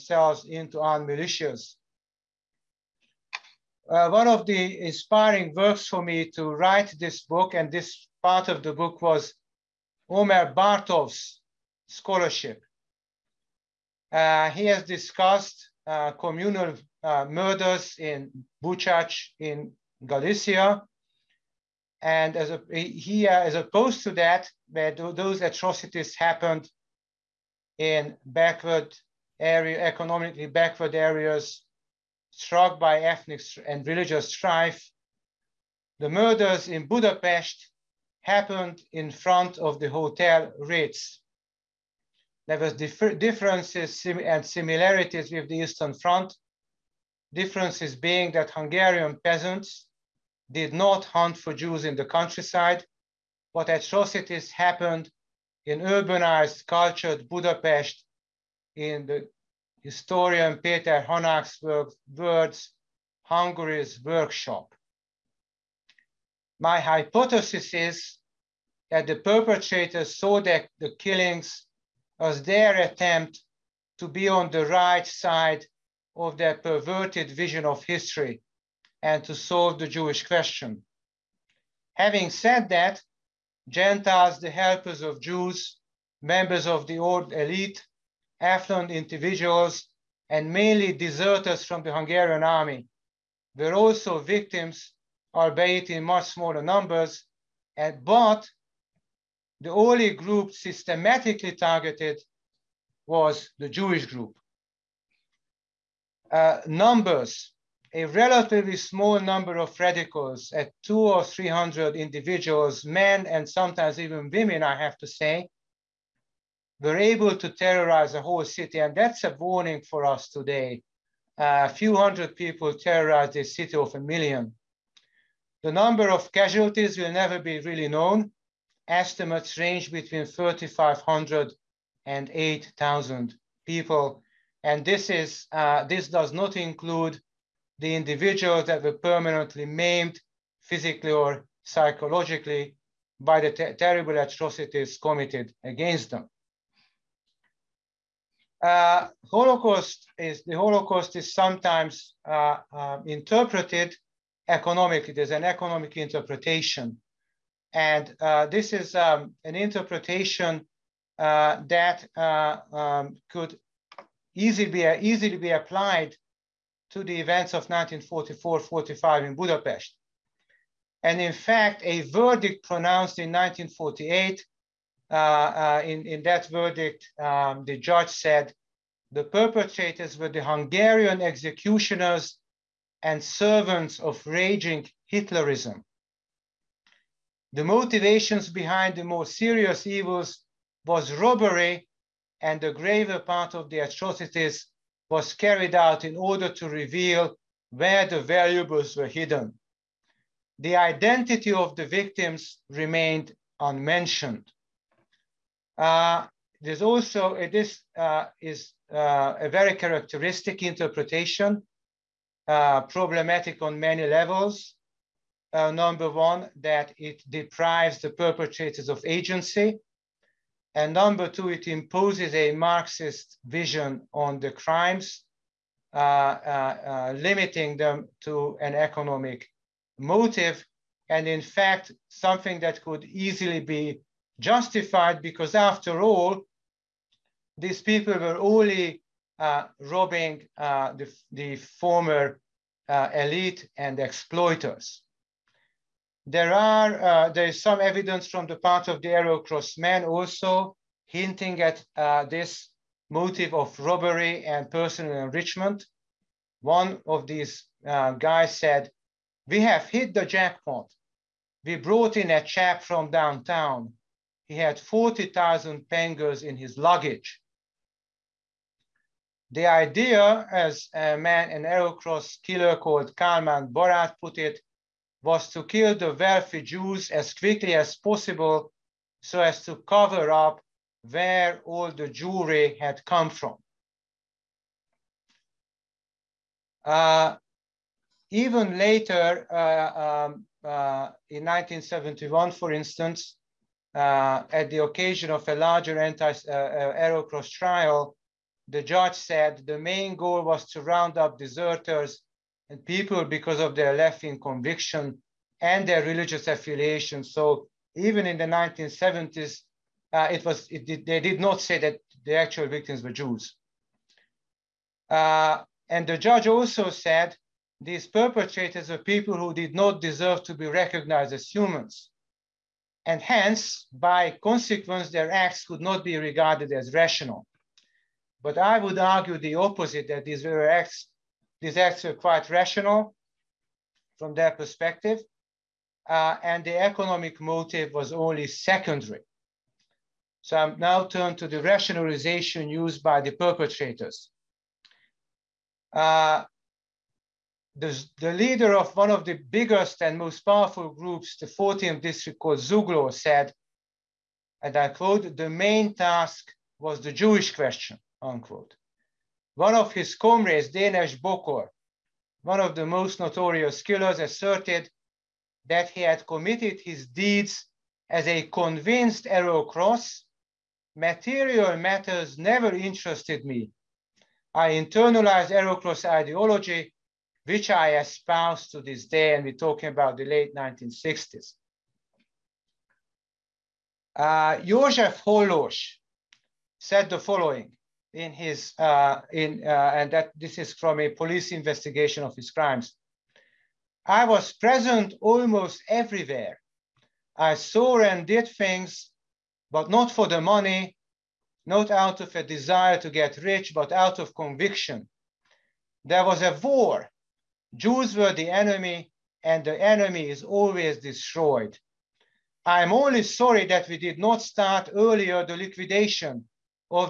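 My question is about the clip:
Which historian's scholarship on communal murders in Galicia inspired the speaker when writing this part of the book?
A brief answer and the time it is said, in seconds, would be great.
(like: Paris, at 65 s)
Omer Bartov, at 10 s.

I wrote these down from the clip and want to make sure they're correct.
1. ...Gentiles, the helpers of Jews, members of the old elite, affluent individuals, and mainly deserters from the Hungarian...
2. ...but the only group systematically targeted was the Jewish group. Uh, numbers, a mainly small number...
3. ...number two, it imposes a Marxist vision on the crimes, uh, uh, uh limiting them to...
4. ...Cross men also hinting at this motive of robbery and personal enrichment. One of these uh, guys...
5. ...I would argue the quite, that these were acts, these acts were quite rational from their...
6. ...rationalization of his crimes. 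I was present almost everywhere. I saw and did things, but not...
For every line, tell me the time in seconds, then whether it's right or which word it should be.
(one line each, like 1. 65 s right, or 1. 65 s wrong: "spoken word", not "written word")
1. 83 s right
2. 98 s wrong: "relatively", not "mainly"
3. 220 s right
4. 249 s right
5. 328 s wrong: "opposite", not "quite"
6. 391 s wrong: "investigation", not "rationalization".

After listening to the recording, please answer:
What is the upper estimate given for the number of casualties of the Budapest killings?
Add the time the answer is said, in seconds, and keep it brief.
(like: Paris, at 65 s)
8,000, at 132 s.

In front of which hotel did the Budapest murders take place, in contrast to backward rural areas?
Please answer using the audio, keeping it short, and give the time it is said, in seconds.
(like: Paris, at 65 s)
Ritz, at 40 s.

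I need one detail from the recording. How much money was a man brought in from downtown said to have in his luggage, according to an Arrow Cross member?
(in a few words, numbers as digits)
40,000 pengos.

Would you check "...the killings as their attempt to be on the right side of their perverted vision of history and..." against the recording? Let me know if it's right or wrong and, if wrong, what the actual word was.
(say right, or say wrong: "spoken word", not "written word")
right.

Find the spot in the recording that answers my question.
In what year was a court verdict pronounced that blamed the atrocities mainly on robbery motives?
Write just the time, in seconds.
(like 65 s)
173 s.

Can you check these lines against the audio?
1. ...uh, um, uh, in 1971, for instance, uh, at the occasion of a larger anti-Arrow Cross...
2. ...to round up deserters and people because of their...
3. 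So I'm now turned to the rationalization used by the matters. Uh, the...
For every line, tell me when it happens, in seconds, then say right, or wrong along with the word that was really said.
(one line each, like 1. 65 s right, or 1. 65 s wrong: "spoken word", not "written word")
1. 289 s right
2. 300 s right
3. 340 s wrong: "perpetrators", not "matters".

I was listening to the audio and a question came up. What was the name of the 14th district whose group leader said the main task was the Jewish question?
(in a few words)
Zuglo.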